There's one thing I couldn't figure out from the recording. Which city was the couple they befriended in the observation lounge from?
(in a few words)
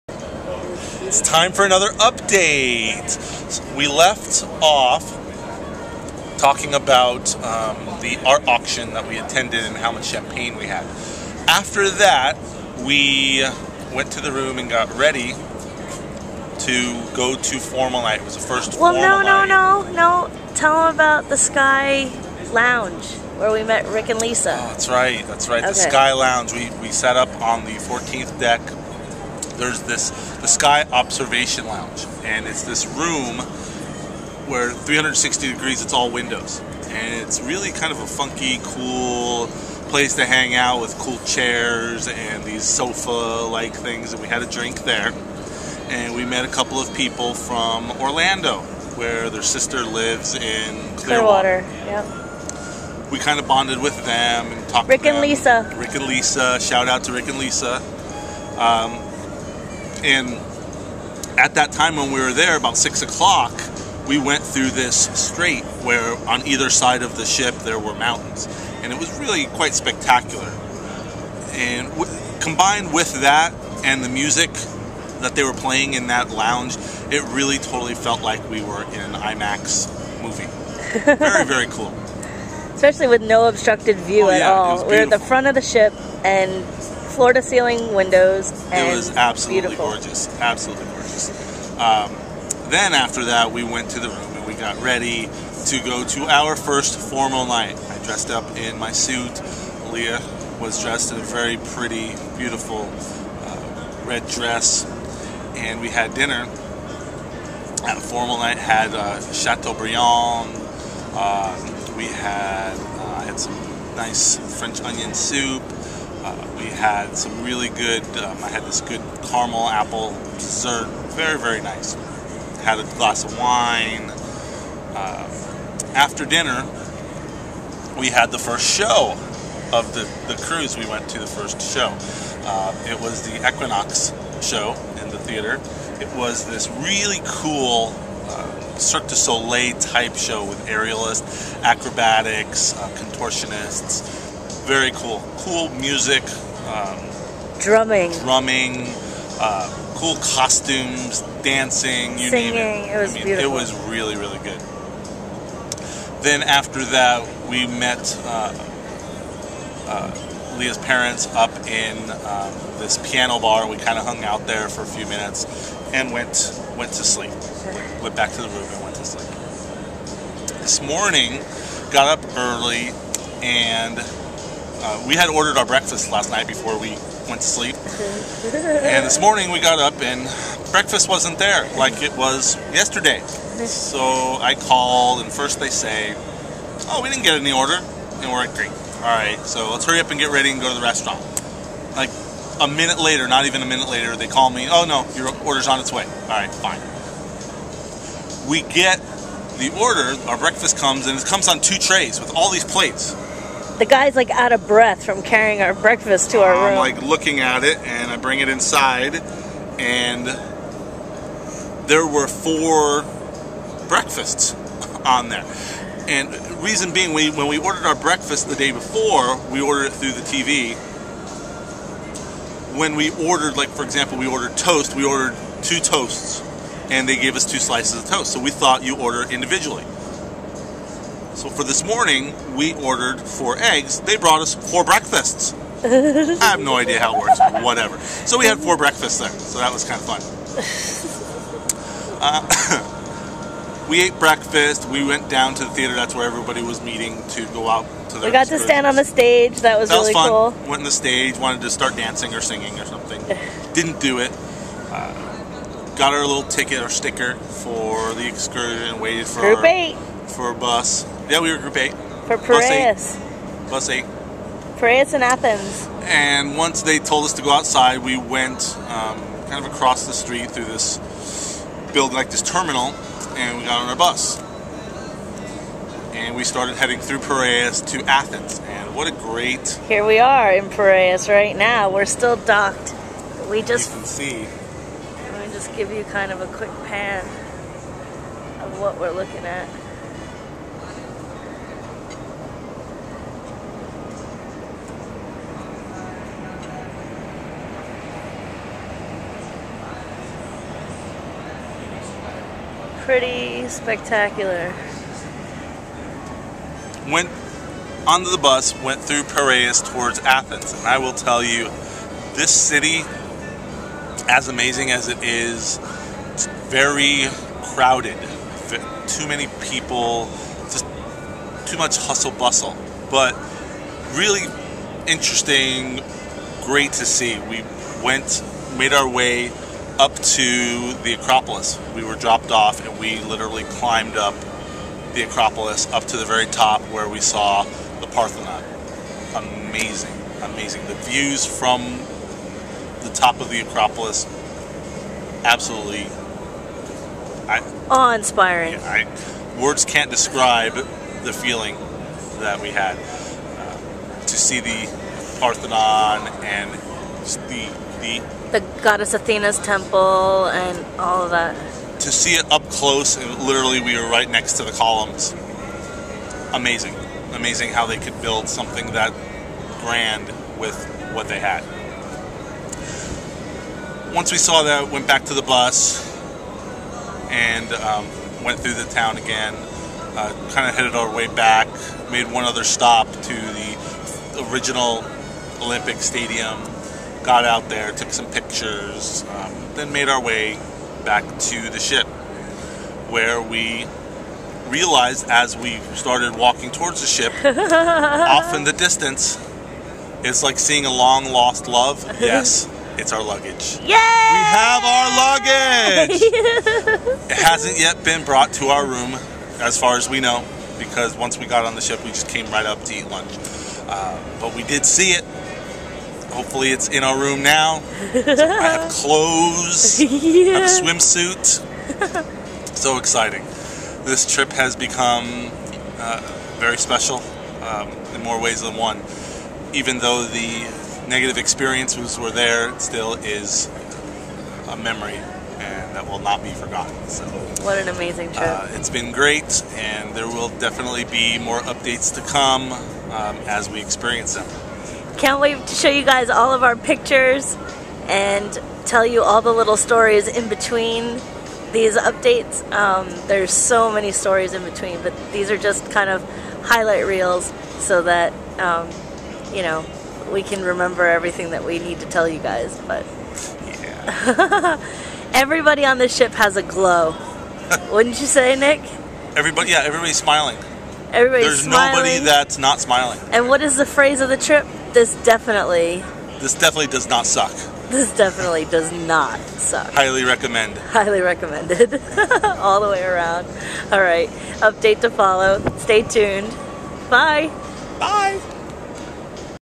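Orlando.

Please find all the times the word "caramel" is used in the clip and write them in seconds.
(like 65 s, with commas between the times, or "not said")
119 s.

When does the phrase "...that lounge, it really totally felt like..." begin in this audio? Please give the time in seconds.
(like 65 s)
76 s.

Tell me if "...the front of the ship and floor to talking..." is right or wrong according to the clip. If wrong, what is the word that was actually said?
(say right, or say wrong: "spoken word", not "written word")
wrong: "ceiling", not "talking".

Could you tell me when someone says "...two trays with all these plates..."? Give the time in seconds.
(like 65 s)
201 s.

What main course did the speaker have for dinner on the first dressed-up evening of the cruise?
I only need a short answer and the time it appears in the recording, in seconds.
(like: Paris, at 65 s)
Chateaubriand, at 109 s.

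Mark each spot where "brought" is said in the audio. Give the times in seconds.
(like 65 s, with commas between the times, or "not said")
234 s, 408 s.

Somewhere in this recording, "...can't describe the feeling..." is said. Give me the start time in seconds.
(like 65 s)
349 s.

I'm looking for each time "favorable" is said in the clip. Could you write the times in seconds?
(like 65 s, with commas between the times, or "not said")
not said.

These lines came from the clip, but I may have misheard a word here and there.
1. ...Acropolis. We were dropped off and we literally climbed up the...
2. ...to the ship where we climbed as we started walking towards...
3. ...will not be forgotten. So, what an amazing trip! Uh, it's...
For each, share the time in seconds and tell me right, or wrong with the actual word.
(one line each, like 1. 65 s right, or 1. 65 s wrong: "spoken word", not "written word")
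1. 331 s right
2. 391 s wrong: "realized", not "climbed"
3. 436 s right.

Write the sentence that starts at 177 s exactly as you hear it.
and this morning we got up and breakfast wasn't there like it was yesterday.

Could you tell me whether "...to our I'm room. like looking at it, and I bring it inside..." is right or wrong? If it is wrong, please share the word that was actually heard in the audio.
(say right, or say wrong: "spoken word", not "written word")
right.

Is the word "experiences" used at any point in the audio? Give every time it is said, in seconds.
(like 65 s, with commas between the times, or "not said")
431 s, 443 s.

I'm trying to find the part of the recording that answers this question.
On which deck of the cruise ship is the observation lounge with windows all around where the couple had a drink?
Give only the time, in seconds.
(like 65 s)
27 s.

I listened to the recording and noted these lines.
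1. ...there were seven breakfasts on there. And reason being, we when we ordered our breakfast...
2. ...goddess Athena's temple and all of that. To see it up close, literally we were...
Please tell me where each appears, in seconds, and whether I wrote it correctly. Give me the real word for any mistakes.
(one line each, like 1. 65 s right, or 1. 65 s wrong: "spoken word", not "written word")
1. 211 s wrong: "four", not "seven"
2. 358 s right.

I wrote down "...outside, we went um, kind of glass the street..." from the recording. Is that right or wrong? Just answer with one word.
wrong.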